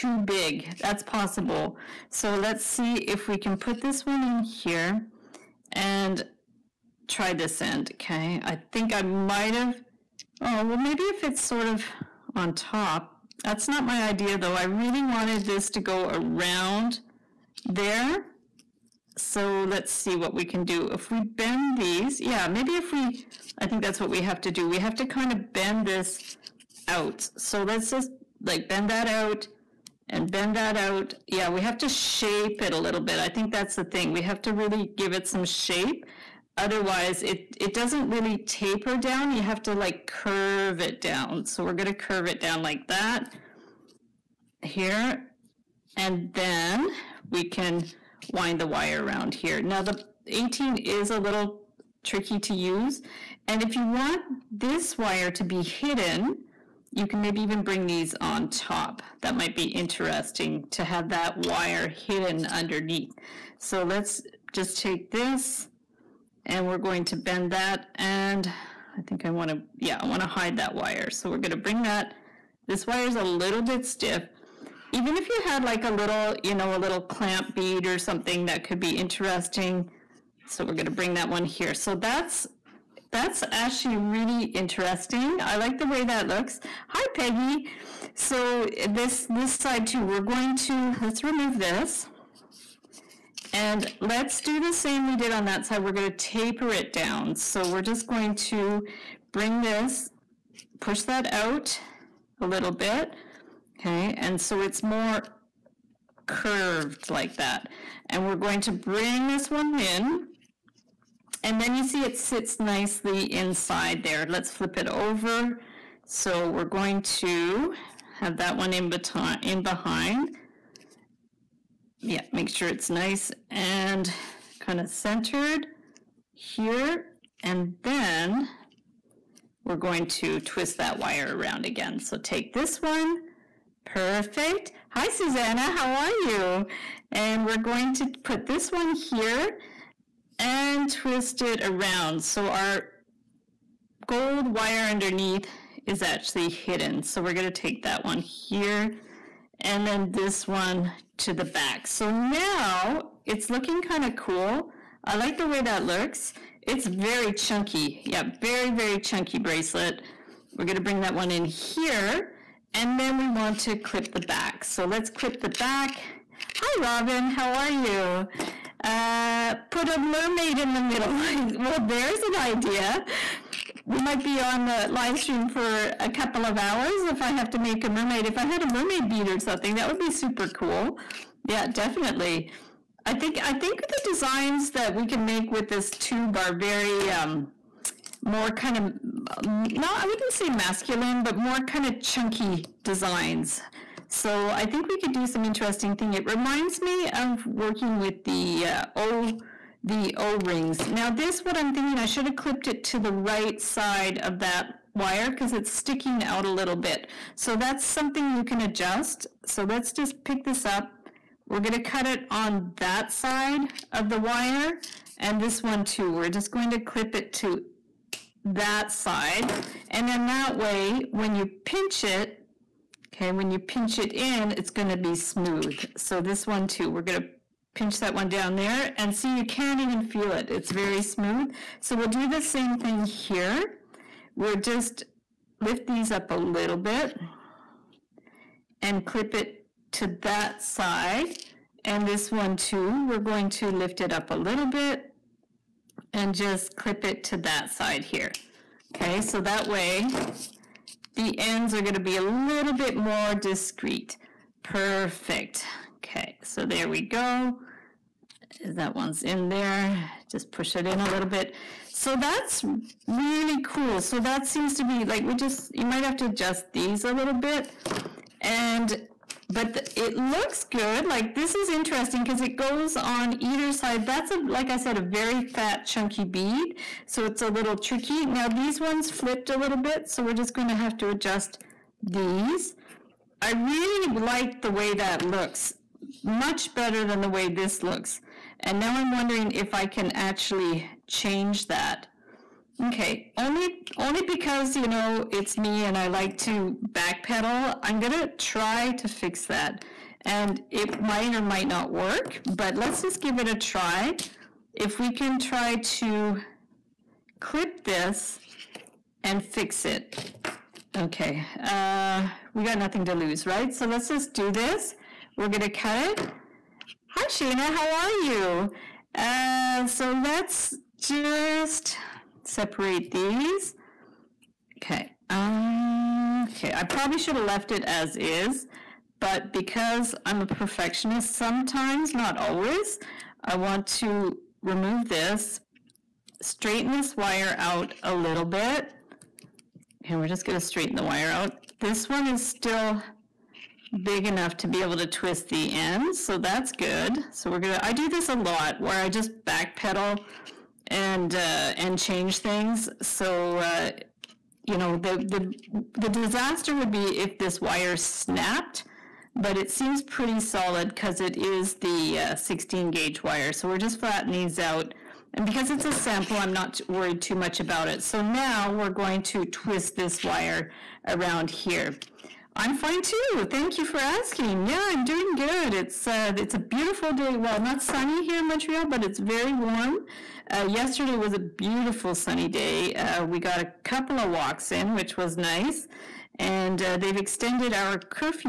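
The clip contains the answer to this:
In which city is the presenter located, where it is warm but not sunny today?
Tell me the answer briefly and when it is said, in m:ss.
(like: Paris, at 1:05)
Montreal, at 6:18.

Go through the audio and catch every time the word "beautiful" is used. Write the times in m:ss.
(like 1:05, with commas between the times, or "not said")
6:16, 6:21.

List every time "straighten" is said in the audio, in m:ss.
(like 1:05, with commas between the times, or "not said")
5:36, 5:40.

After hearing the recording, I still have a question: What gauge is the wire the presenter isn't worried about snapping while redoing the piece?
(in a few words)
16.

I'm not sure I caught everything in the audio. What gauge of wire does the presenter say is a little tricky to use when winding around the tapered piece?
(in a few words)
18.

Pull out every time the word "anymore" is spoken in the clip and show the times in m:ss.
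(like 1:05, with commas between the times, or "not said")
not said.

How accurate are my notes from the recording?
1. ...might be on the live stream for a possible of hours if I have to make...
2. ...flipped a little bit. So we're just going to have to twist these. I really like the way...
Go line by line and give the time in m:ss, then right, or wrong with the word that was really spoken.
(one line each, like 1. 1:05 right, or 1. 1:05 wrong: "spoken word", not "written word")
1. 2:54 wrong: "couple", not "possible"
2. 4:39 wrong: "adjust", not "twist".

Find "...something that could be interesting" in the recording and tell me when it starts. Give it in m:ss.
1:17.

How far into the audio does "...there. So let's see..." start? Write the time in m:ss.
0:17.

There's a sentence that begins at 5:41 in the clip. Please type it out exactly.
This one is still big enough to be able to twist the ends, so that's good.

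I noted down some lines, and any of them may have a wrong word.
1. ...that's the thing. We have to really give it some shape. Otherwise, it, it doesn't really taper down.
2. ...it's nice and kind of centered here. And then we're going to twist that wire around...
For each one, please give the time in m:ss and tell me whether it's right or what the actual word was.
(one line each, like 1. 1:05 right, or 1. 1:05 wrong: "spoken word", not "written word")
1. 0:33 right
2. 2:02 right.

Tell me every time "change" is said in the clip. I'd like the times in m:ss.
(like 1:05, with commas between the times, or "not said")
4:51, 5:51.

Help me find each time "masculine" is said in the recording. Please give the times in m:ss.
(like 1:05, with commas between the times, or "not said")
3:10.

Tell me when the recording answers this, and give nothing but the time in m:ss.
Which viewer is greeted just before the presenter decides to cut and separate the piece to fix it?
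5:17.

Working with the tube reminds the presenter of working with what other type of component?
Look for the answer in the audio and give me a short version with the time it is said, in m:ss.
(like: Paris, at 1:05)
O rings, at 3:20.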